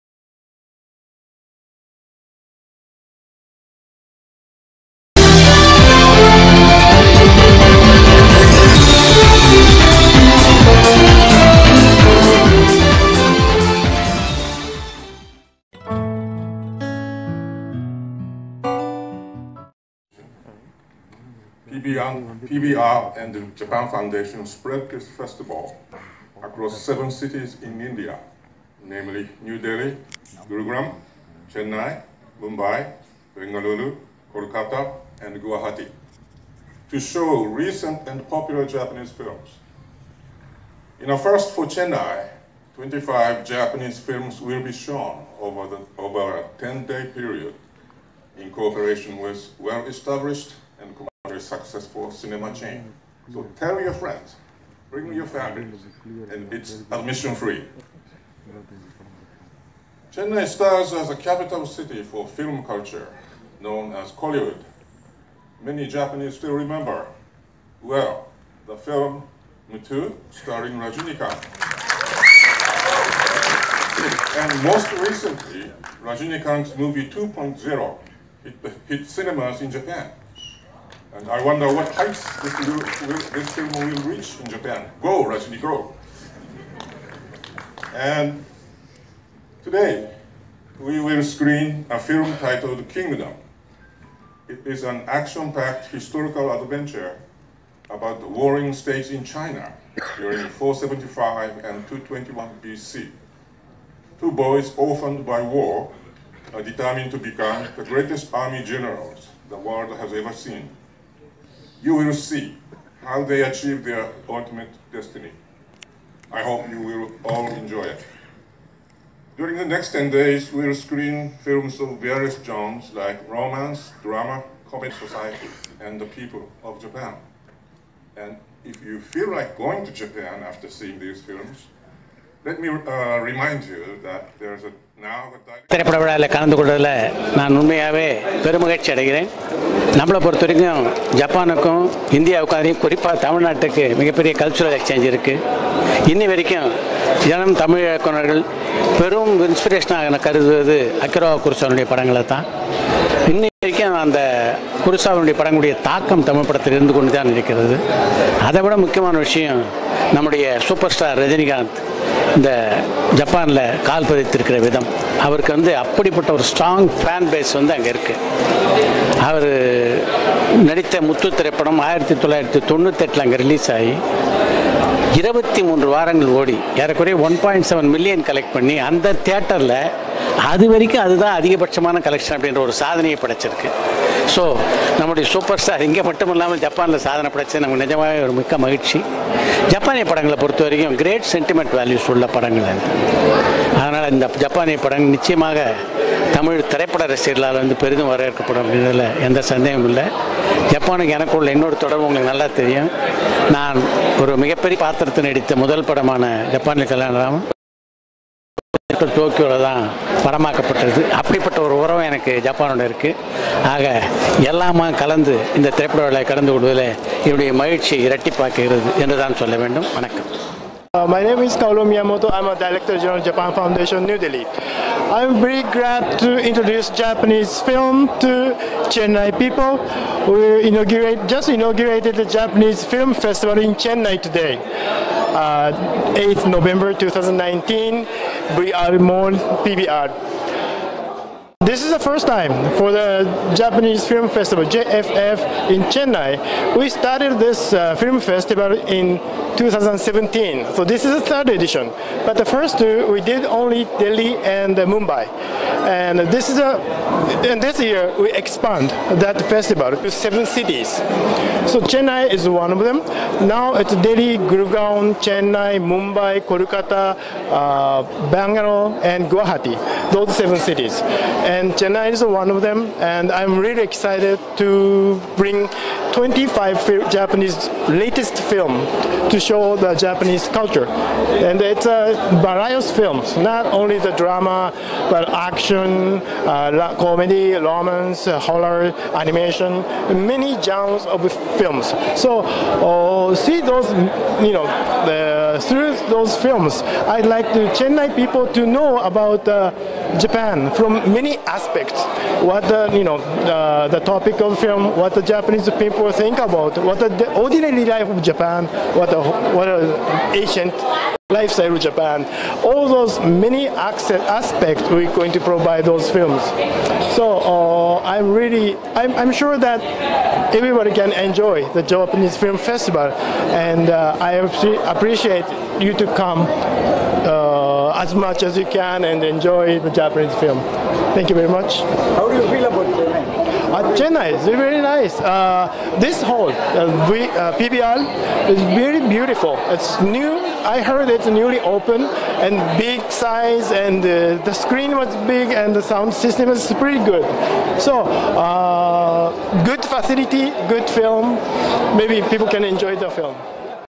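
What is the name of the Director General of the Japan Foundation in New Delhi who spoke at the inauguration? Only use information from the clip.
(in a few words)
Kaoru Miyamoto.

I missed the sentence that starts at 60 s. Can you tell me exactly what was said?
Chennai stars as a capital city for film culture, known as Kollywood.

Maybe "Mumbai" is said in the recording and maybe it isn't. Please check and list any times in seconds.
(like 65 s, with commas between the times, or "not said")
32 s, 254 s, 265 s.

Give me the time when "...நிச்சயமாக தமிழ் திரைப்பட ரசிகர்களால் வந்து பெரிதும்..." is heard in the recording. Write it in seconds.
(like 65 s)
195 s.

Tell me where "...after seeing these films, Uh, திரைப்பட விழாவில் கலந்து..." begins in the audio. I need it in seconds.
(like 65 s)
130 s.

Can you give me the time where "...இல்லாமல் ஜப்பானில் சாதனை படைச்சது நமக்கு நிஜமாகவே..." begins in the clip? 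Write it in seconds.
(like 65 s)
186 s.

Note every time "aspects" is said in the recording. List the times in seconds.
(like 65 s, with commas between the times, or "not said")
301 s, 313 s.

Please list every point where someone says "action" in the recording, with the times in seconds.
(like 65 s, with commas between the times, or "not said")
95 s, 285 s.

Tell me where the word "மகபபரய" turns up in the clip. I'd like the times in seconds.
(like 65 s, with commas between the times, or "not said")
143 s, 204 s.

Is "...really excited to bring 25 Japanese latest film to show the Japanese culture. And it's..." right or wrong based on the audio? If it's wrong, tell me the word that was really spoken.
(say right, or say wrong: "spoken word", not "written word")
right.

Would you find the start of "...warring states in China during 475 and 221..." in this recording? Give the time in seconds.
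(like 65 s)
98 s.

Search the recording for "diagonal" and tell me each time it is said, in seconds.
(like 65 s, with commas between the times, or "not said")
not said.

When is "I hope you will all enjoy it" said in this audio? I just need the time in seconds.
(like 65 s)
116 s.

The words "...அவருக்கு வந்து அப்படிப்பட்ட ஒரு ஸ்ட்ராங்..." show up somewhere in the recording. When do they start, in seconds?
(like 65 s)
165 s.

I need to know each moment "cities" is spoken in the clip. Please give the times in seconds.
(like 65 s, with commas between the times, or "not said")
27 s, 260 s, 270 s.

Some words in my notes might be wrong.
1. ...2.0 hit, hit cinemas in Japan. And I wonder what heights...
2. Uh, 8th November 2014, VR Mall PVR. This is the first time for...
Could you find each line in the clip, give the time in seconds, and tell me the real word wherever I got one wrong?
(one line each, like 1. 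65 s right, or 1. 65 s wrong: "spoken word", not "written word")
1. 77 s right
2. 235 s wrong: "2019", not "2014".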